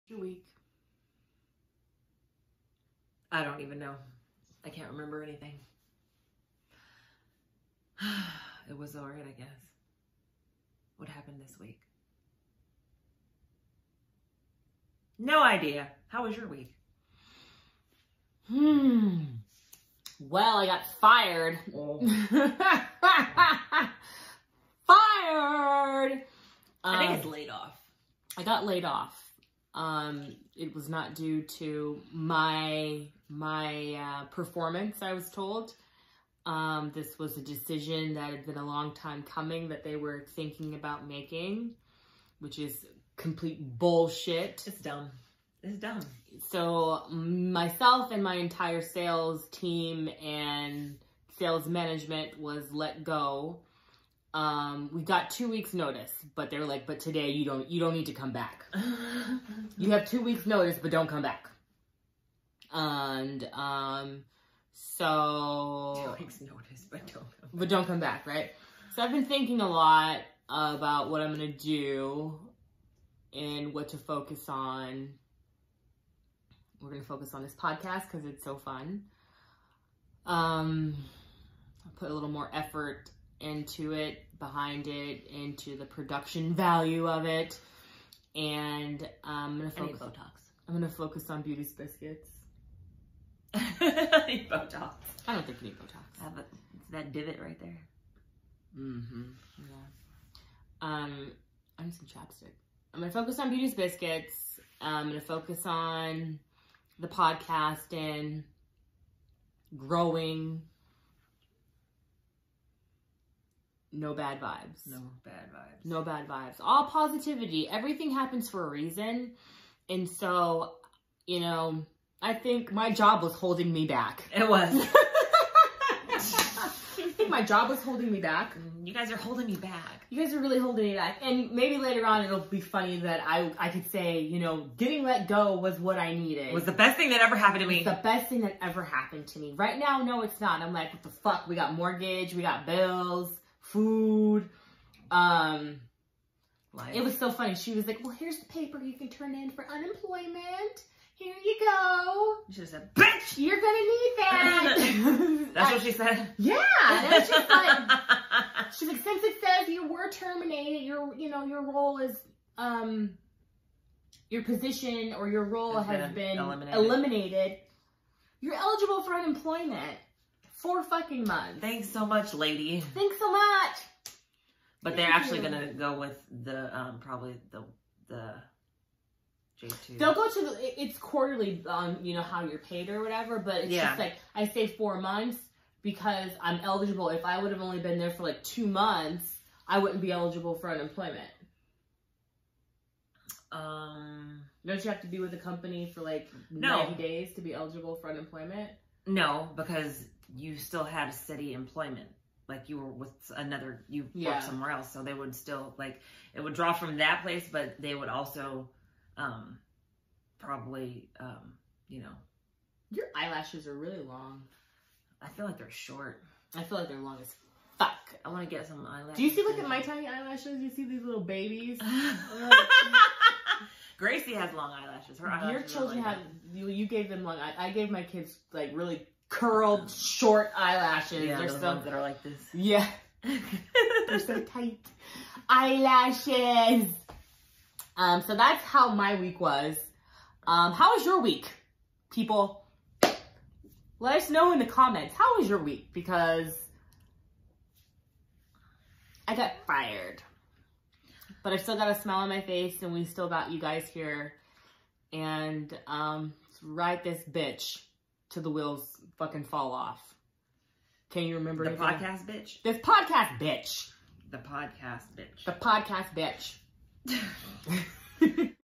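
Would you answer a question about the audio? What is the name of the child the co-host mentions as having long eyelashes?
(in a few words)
Gracie.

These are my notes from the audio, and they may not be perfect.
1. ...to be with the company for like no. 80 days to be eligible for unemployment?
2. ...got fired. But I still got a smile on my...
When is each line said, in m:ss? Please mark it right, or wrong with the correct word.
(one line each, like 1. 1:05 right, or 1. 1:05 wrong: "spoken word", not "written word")
1. 3:15 wrong: "90", not "80"
2. 4:09 right.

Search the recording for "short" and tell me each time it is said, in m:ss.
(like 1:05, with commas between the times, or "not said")
3:35, 3:49.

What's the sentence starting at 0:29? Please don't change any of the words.
Um, it was not due to my my uh, performance, I was told.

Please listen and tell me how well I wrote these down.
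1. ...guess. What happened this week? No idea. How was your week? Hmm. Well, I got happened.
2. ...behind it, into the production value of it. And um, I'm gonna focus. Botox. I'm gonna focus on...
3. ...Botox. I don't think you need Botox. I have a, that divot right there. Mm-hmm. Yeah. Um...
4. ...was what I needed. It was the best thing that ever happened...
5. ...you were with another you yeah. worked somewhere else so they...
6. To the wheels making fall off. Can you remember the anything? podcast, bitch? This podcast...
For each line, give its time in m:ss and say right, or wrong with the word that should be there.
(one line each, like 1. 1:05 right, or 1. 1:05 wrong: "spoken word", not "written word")
1. 0:09 wrong: "fired", not "happened"
2. 1:24 right
3. 1:34 right
4. 2:15 right
5. 3:22 right
6. 4:18 wrong: "fucking", not "making".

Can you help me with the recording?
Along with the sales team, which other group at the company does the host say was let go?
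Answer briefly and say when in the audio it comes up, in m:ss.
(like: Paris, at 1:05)
sales management, at 0:51.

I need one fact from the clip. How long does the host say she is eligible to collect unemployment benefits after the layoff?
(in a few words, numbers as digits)
4 months.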